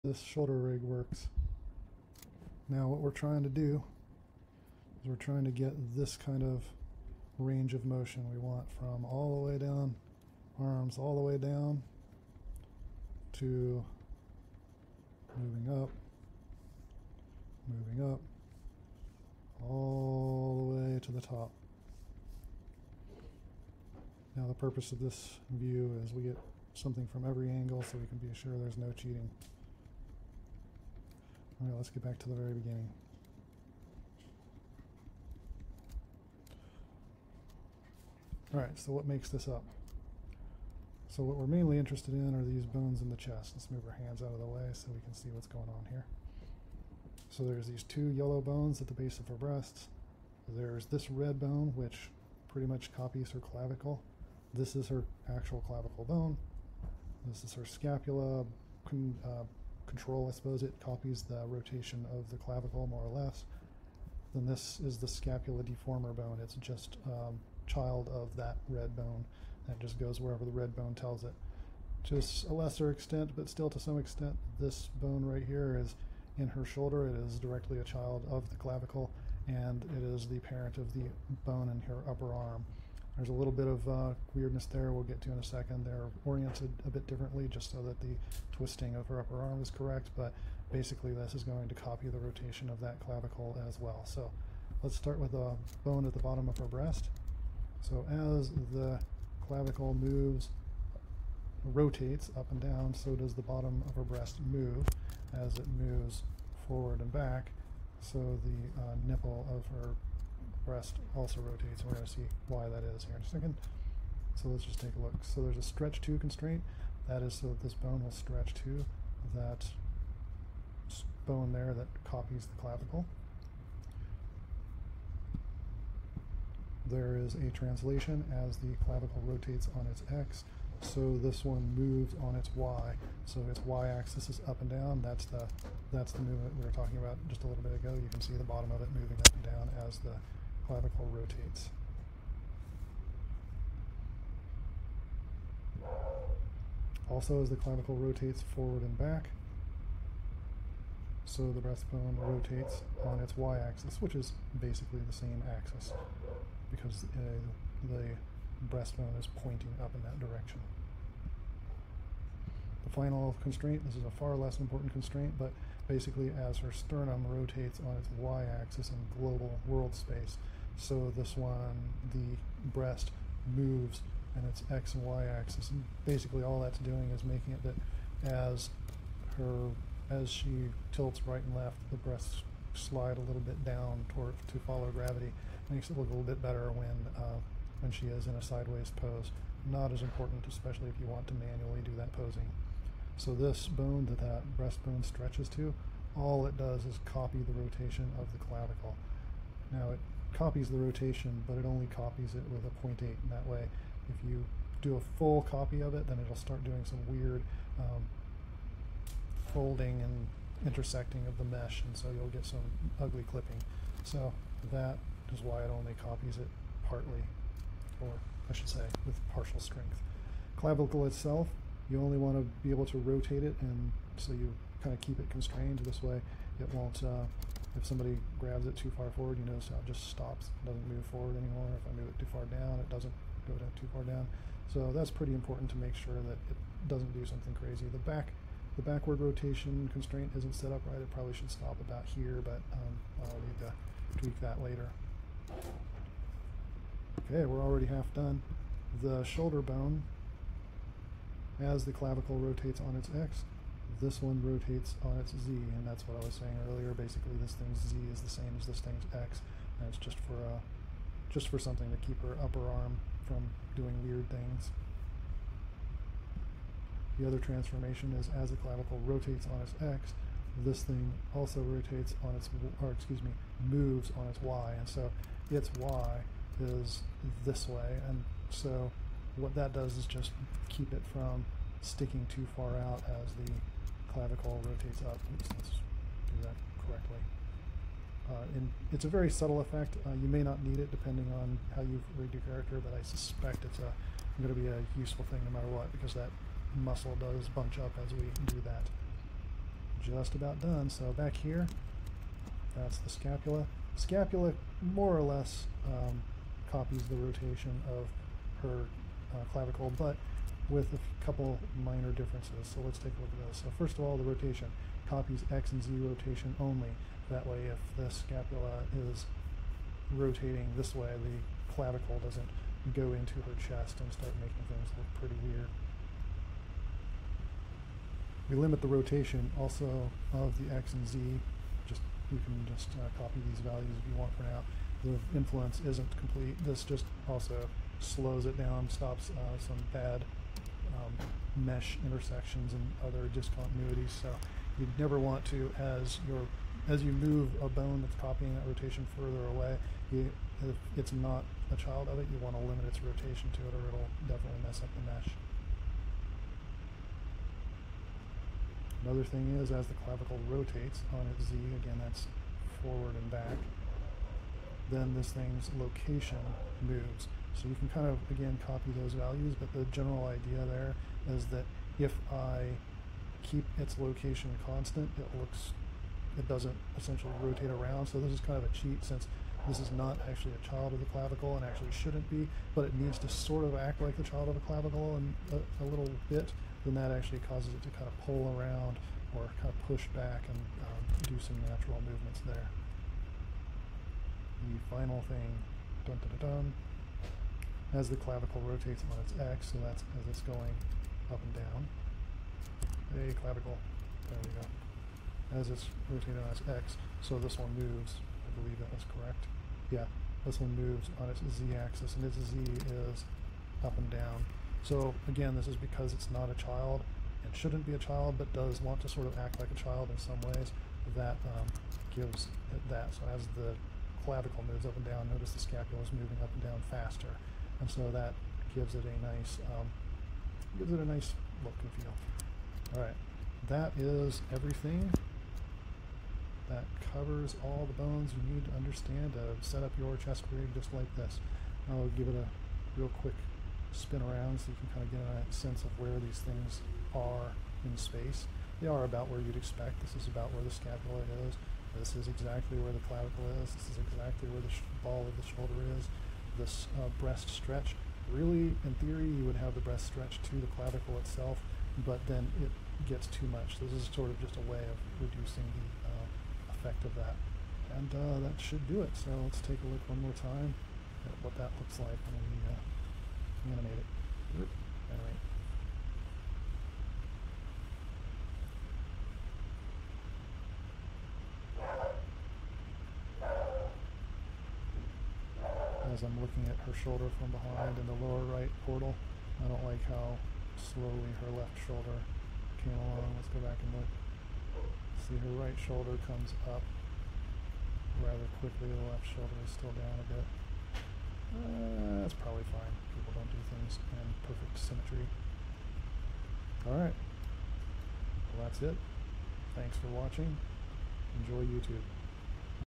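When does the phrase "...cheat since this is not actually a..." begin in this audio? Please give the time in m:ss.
6:18.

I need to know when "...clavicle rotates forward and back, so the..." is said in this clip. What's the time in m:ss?
2:27.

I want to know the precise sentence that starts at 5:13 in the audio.
So first of all, the rotation copies X and Z rotation only.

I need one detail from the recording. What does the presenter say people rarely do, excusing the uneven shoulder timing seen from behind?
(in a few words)
Perfect symmetry.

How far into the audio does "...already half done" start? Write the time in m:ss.
4:07.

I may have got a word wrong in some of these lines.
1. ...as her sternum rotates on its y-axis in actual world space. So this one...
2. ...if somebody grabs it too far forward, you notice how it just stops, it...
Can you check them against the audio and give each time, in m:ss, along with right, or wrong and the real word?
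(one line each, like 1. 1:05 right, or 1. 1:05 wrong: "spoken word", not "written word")
1. 2:46 wrong: "global", not "actual"
2. 3:47 right.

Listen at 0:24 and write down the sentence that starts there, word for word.
Now the purpose of this view is we get something from every angle so we can be sure there's no cheating.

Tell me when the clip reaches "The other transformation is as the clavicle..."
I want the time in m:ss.
4:27.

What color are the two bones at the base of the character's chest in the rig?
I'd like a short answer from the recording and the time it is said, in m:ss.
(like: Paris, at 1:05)
Yellow, at 0:48.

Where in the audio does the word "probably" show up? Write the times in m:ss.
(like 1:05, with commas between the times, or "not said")
4:01, 8:22.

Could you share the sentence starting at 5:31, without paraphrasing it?
Just You can just uh, copy these values if you want for now the influence isn't complete.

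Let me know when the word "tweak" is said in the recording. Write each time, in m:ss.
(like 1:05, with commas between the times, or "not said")
4:04.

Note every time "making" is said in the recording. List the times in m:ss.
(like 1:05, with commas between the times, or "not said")
2:57, 5:24.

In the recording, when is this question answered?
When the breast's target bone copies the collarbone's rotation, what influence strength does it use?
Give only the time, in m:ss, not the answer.
3:22.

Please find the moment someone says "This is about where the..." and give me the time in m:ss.
7:29.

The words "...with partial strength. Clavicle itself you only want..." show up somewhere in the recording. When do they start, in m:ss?
3:39.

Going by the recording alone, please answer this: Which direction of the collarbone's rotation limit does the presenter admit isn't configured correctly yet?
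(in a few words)
Backward rotation.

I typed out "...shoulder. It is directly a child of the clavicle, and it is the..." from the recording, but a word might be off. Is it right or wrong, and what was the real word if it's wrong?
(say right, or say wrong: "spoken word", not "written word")
right.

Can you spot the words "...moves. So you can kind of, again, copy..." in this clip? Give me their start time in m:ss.
6:06.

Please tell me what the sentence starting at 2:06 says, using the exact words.
There is a translation as the clavicle rotates on its x, so this one moves on its y.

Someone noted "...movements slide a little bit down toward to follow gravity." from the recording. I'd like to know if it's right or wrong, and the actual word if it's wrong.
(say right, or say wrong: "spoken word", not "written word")
wrong: "breasts", not "movements".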